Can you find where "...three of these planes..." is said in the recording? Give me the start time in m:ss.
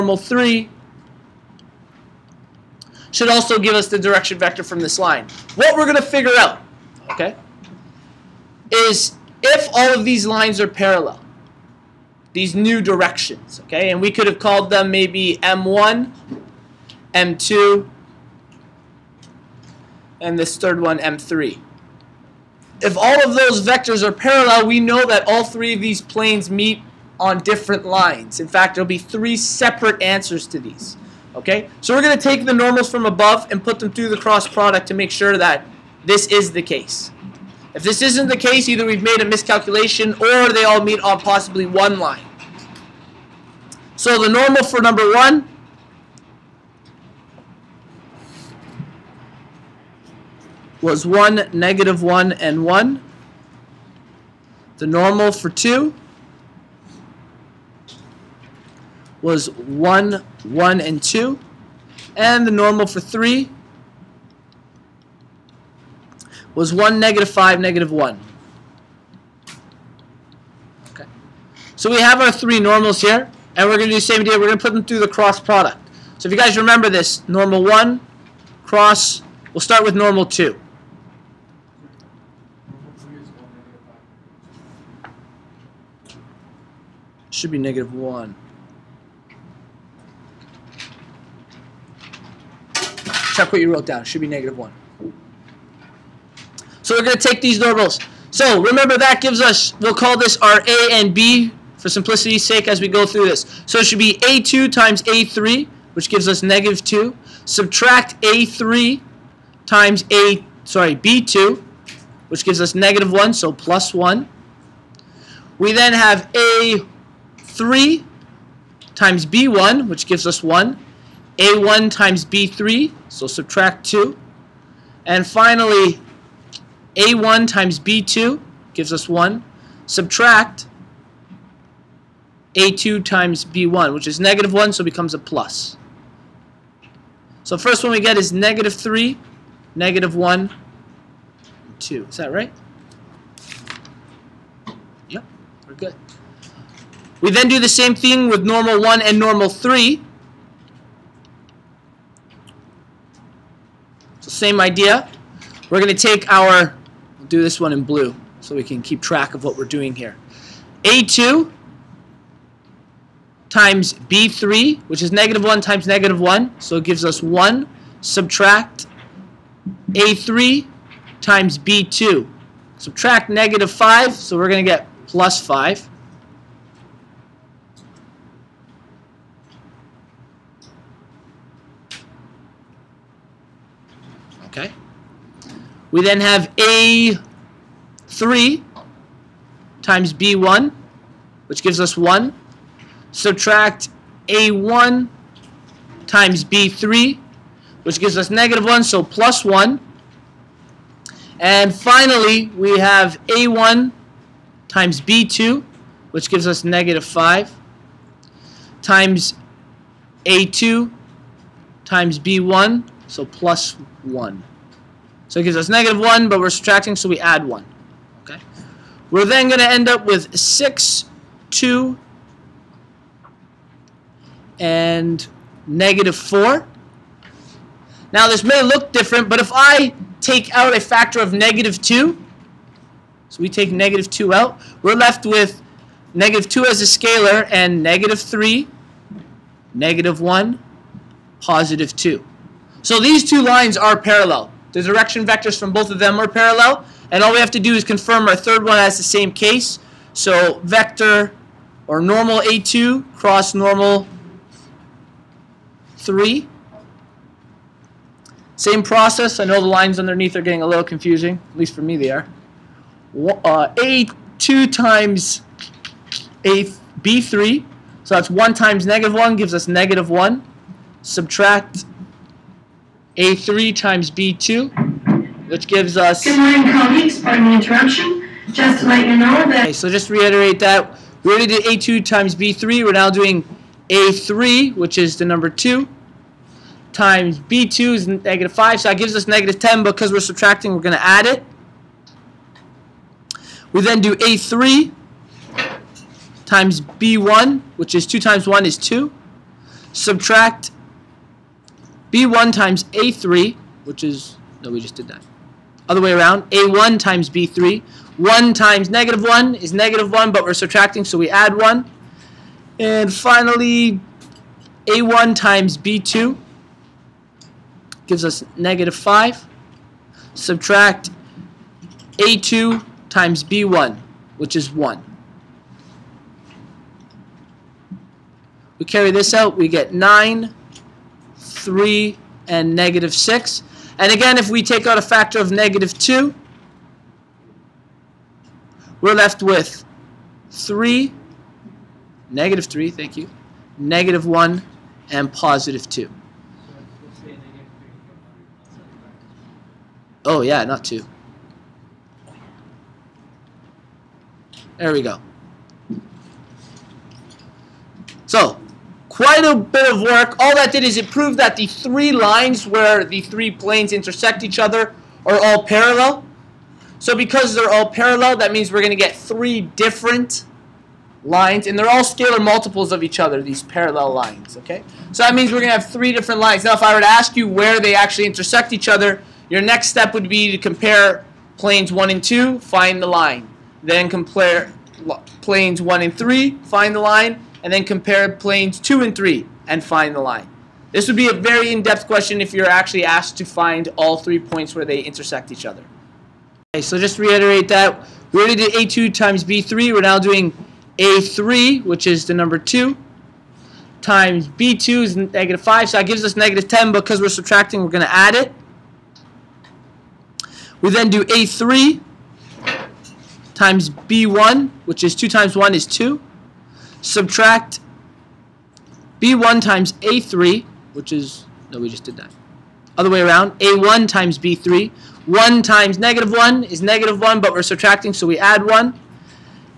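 0:25.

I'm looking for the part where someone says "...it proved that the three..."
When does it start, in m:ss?
6:00.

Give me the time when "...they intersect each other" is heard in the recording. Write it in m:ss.
6:34.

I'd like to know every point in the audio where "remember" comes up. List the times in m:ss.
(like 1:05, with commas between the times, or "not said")
1:16, 1:38.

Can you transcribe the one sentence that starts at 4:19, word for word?
I know the lines underneath are getting a little confusing.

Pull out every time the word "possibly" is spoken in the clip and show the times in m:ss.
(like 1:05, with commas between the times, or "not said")
0:41.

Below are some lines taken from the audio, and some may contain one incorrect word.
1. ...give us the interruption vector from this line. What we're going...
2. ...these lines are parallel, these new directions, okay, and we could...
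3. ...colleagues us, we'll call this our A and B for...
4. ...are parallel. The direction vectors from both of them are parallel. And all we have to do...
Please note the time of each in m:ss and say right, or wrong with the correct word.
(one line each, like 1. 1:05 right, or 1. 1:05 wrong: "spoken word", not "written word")
1. 0:03 wrong: "direction", not "interruption"
2. 0:10 right
3. 1:39 wrong: "gives", not "colleagues"
4. 4:03 right.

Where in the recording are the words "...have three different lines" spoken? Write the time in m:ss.
6:15.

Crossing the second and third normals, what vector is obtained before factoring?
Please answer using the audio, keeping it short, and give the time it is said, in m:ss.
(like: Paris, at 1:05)
9, 3, -6, at 5:29.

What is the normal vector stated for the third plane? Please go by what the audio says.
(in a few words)
1, -5, -1.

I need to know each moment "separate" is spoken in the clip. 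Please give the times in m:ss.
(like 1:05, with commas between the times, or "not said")
0:29.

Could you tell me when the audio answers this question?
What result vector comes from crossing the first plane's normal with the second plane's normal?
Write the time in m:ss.
2:18.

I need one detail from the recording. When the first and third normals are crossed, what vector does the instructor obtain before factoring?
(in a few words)
6, 2, -4.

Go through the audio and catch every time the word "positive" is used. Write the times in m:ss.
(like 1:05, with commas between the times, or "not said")
4:01, 5:45.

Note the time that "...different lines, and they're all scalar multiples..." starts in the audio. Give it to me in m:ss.
6:09.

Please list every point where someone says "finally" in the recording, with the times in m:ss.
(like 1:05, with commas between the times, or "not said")
2:05, 3:21, 5:13.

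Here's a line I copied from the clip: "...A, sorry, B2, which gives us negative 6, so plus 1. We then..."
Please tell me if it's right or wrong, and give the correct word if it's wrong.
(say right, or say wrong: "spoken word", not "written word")
wrong: "1", not "6".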